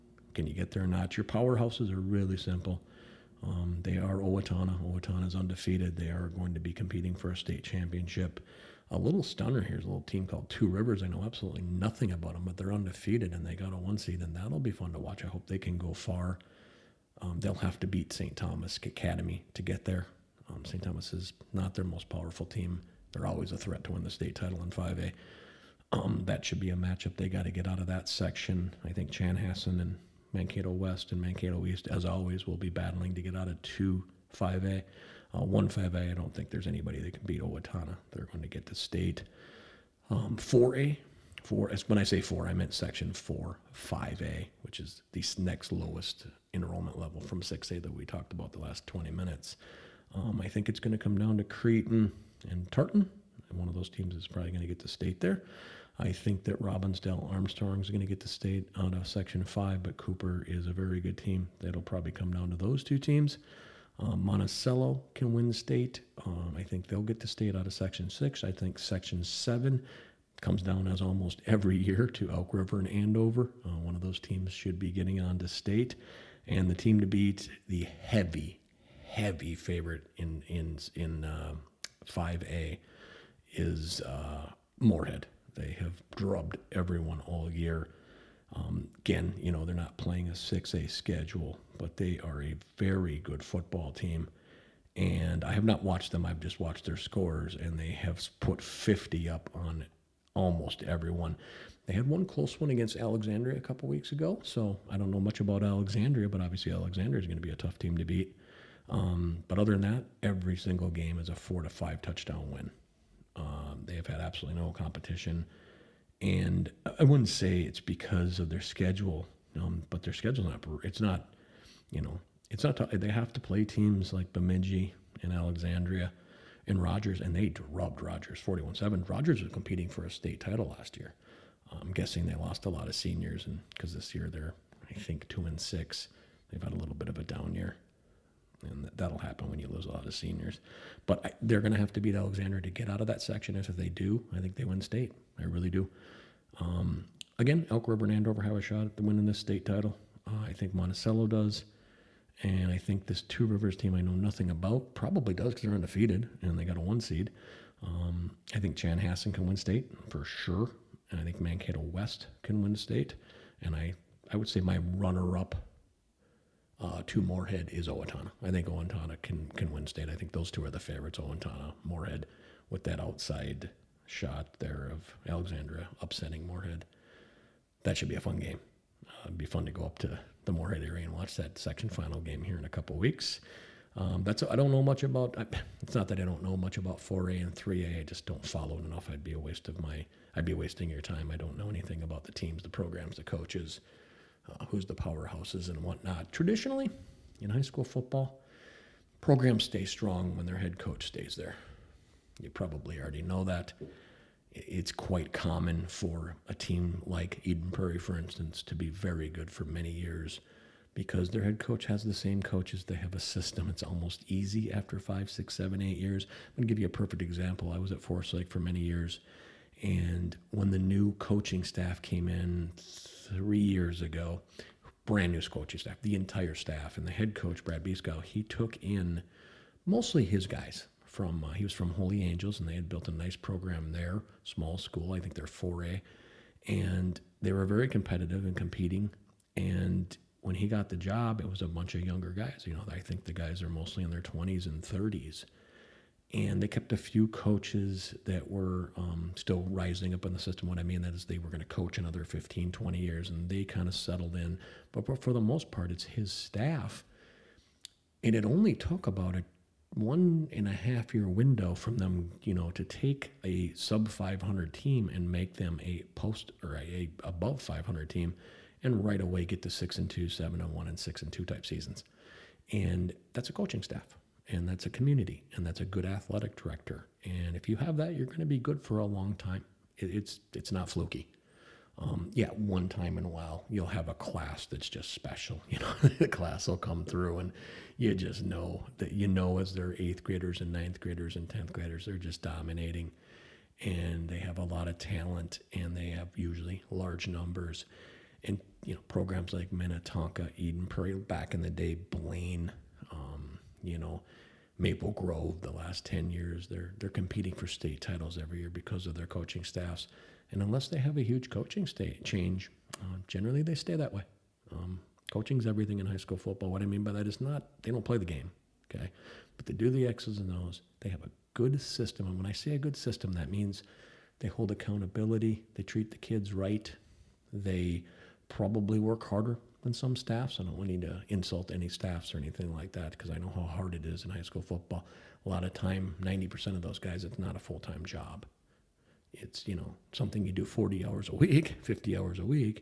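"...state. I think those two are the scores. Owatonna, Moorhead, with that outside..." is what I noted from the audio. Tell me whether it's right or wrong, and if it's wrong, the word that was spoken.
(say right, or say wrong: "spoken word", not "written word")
wrong: "favorites", not "scores".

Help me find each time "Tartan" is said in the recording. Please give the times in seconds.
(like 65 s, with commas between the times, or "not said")
52 s.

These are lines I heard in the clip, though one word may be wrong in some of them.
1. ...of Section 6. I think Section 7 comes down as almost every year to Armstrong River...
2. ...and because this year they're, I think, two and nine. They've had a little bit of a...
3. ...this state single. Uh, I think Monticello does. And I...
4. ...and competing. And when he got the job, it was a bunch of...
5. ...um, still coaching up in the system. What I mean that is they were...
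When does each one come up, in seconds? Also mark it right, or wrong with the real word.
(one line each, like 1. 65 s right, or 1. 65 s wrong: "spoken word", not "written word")
1. 67 s wrong: "Elk", not "Armstrong"
2. 133 s wrong: "six", not "nine"
3. 149 s wrong: "title", not "single"
4. 238 s right
5. 248 s wrong: "rising", not "coaching".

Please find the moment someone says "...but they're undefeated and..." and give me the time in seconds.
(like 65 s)
12 s.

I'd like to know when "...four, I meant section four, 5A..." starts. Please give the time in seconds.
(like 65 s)
42 s.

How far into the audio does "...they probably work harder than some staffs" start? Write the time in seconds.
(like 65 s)
327 s.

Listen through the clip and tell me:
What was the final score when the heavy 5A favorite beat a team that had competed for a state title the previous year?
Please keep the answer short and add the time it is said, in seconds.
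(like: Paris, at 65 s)
41-7, at 128 s.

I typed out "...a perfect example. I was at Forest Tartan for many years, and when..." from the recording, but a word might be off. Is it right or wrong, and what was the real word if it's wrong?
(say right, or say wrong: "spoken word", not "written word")
wrong: "Lake", not "Tartan".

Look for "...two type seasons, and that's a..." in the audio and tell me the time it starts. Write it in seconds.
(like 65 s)
271 s.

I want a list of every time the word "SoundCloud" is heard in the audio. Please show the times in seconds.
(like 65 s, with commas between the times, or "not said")
not said.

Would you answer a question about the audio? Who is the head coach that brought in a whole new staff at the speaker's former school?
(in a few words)
Brad Bieskow.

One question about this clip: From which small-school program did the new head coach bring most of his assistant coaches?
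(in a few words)
Holy Angels.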